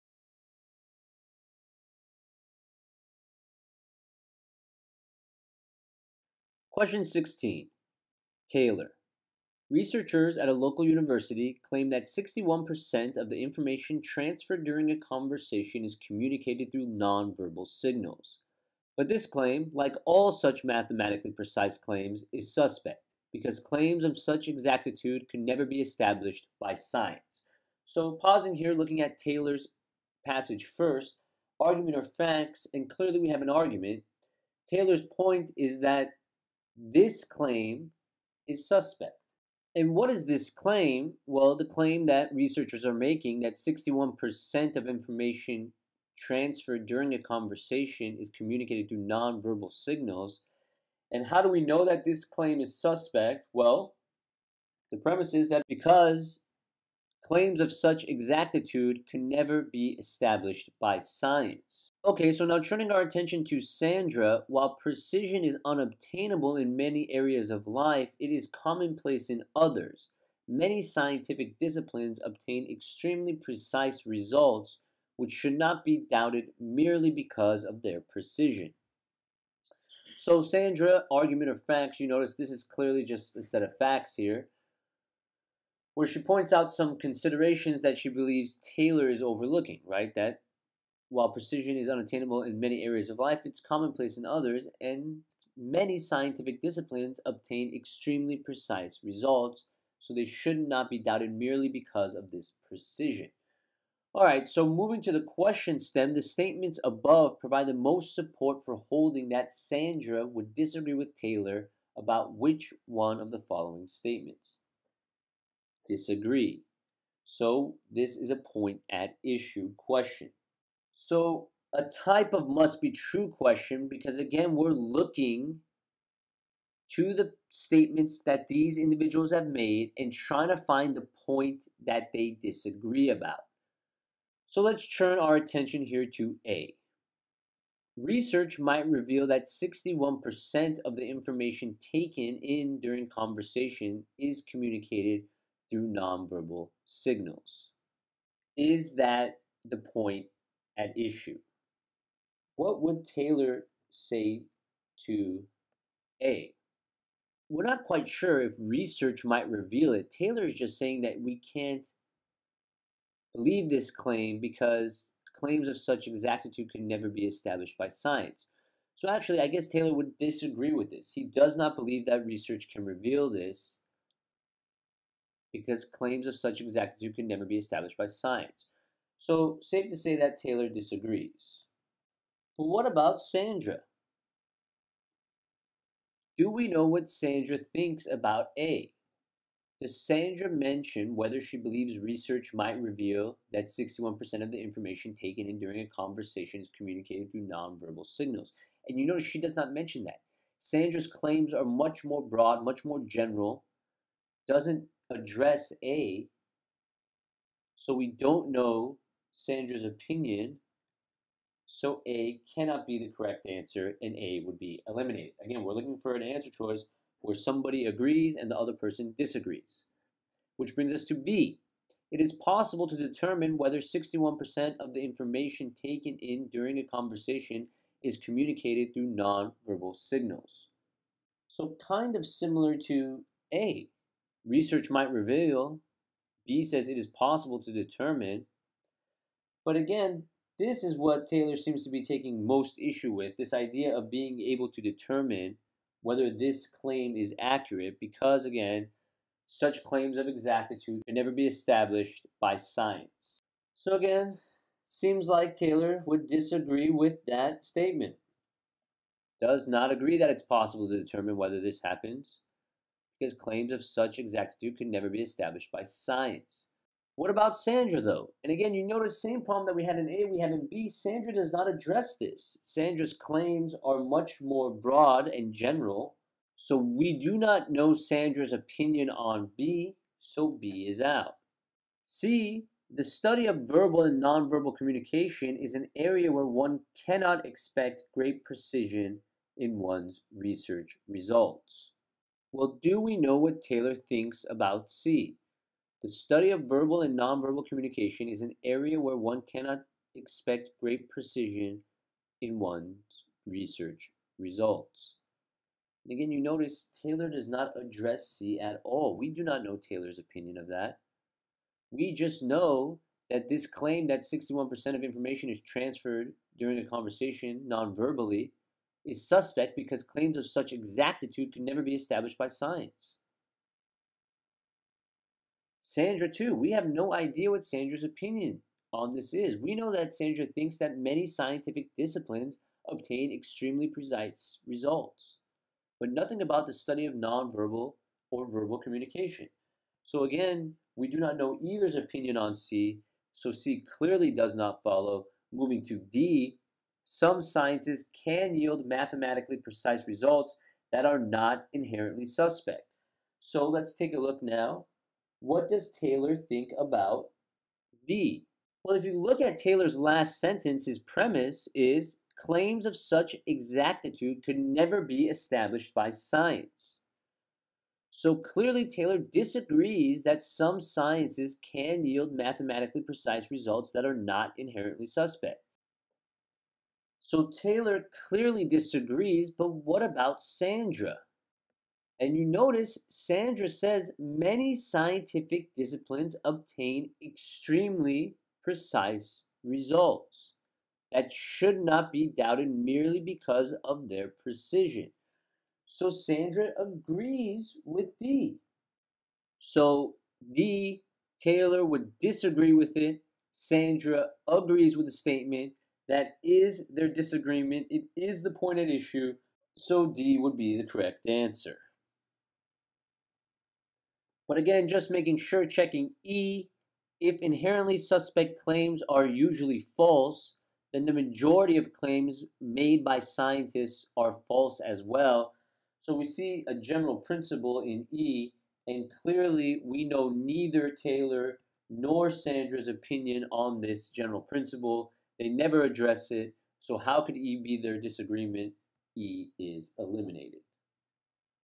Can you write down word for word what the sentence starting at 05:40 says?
So, again, we do not know either's opinion on C, so C clearly does not follow.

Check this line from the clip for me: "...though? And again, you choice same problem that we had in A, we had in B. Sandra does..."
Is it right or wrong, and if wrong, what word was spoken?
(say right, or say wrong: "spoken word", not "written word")
wrong: "notice", not "choice".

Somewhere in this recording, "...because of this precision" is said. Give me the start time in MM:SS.
01:41.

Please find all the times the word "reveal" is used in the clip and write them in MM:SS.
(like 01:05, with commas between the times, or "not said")
02:18, 02:39, 02:52, 03:12, 03:55.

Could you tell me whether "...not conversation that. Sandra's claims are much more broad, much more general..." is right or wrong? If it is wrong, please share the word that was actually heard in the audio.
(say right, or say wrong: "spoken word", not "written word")
wrong: "mention", not "conversation".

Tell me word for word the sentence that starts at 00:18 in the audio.
But this claim, like all such mathematically precise claims, is suspect because claims of such exactitude can never be established by science.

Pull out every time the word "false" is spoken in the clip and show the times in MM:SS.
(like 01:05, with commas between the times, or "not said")
06:59, 07:04.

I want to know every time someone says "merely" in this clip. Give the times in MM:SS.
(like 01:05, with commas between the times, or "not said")
01:16, 01:41, 06:32.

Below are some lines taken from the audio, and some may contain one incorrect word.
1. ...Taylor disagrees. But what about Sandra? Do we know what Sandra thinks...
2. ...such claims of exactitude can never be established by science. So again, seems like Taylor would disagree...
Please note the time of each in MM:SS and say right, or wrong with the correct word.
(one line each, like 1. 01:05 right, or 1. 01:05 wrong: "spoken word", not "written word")
1. 03:00 right
2. 04:09 right.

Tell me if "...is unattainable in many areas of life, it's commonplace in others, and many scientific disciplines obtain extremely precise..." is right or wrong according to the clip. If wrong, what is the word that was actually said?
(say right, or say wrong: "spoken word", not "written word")
right.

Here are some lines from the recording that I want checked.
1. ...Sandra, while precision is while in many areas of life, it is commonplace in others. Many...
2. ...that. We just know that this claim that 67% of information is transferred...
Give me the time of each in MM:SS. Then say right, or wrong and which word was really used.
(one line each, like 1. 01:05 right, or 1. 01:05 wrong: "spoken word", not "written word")
1. 01:03 wrong: "unobtainable", not "while"
2. 05:10 wrong: "61", not "67".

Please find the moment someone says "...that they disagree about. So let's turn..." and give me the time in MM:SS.
02:11.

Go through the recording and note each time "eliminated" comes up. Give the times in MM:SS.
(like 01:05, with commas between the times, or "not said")
03:34, 07:19.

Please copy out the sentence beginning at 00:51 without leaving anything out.
And how do we know that this claim is suspect?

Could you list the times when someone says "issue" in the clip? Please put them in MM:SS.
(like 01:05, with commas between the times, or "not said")
01:59, 02:30, 04:02, 06:48.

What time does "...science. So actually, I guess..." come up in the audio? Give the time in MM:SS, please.
02:47.